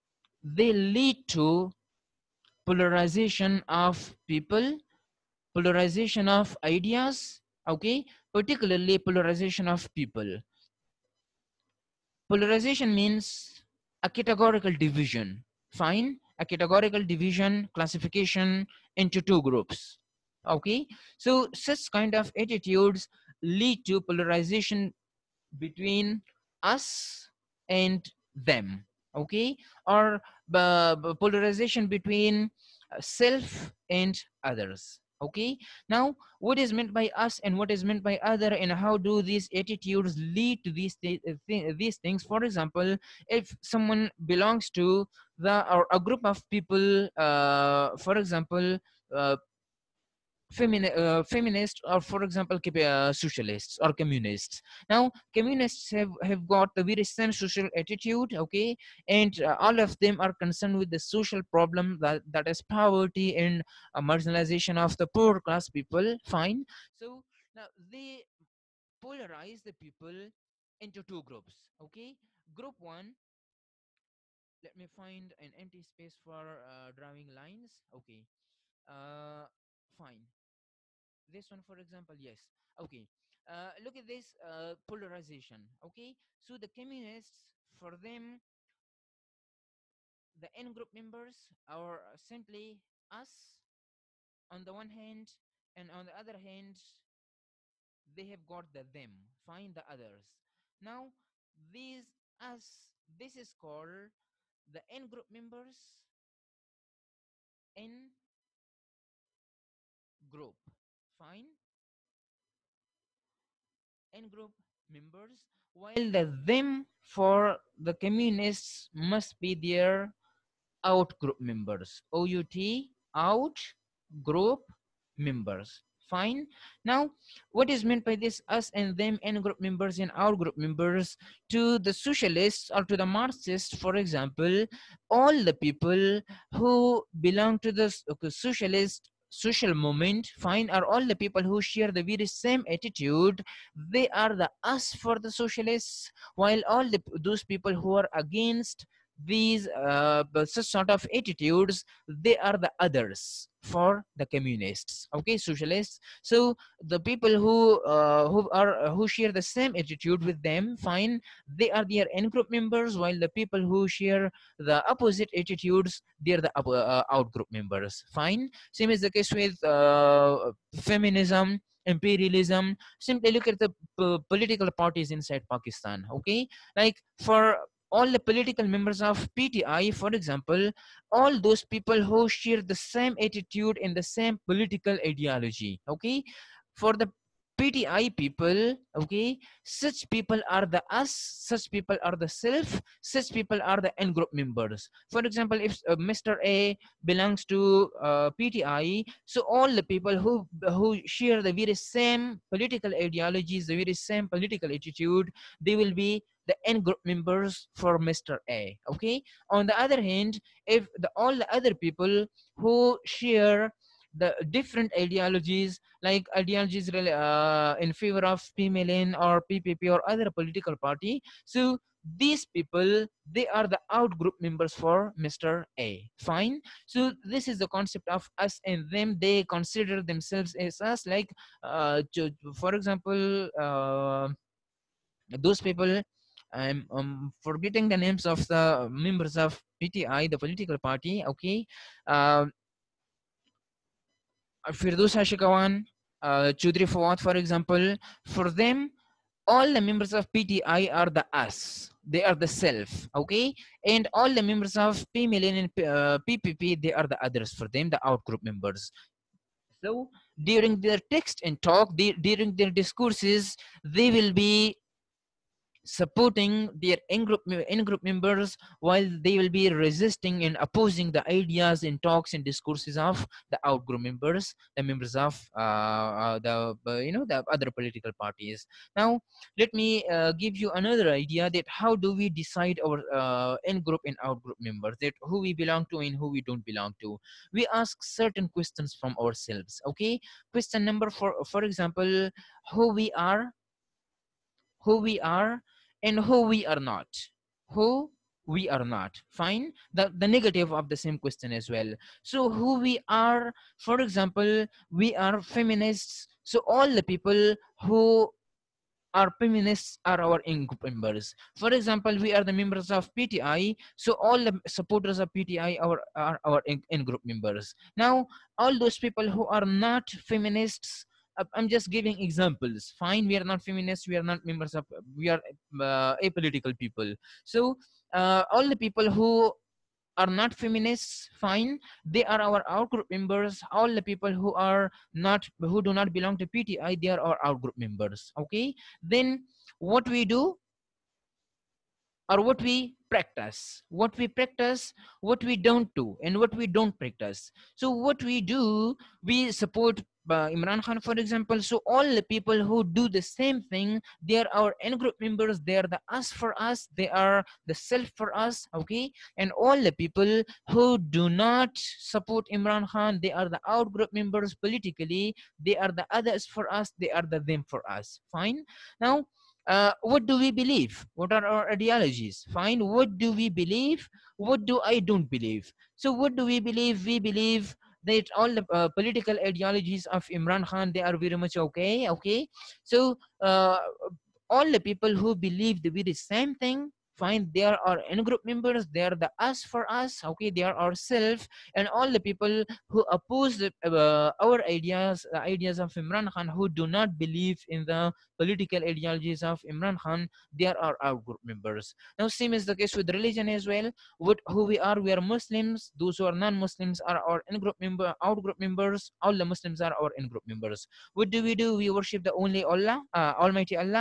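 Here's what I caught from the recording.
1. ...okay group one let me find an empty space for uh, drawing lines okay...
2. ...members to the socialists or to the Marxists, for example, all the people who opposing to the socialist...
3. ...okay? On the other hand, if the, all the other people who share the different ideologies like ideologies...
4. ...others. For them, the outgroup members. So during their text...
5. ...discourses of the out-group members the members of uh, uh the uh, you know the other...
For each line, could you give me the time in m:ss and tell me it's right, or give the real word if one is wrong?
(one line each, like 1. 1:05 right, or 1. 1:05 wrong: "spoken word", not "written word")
1. 1:11 right
2. 2:10 wrong: "belong", not "opposing"
3. 3:28 right
4. 4:17 right
5. 4:32 right.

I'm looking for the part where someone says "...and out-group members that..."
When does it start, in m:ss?
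4:44.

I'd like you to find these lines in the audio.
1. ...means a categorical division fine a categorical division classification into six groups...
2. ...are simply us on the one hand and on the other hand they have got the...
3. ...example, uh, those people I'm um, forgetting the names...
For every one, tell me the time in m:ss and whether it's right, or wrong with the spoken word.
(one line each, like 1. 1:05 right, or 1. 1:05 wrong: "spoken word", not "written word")
1. 0:12 wrong: "two", not "six"
2. 1:31 right
3. 3:52 right.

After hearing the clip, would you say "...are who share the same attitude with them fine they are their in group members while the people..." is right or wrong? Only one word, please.
right.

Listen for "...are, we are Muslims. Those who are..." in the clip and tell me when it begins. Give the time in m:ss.
6:44.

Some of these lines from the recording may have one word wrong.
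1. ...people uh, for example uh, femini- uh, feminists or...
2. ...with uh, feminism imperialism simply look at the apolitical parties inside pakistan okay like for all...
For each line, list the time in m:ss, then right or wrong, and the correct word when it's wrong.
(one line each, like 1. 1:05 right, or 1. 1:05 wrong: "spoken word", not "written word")
1. 0:46 right
2. 2:49 wrong: "political", not "apolitical".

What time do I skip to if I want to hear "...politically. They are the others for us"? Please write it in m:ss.
6:04.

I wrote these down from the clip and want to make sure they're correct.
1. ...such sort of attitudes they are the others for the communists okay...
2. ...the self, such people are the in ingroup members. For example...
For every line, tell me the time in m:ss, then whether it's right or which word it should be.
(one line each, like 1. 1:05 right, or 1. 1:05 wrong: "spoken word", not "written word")
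1. 2:30 right
2. 3:12 wrong: "group", not "ingroup".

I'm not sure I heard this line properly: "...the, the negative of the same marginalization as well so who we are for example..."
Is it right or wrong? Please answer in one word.
wrong.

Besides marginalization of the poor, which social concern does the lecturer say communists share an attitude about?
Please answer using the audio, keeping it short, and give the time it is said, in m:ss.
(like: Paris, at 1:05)
poverty, at 1:02.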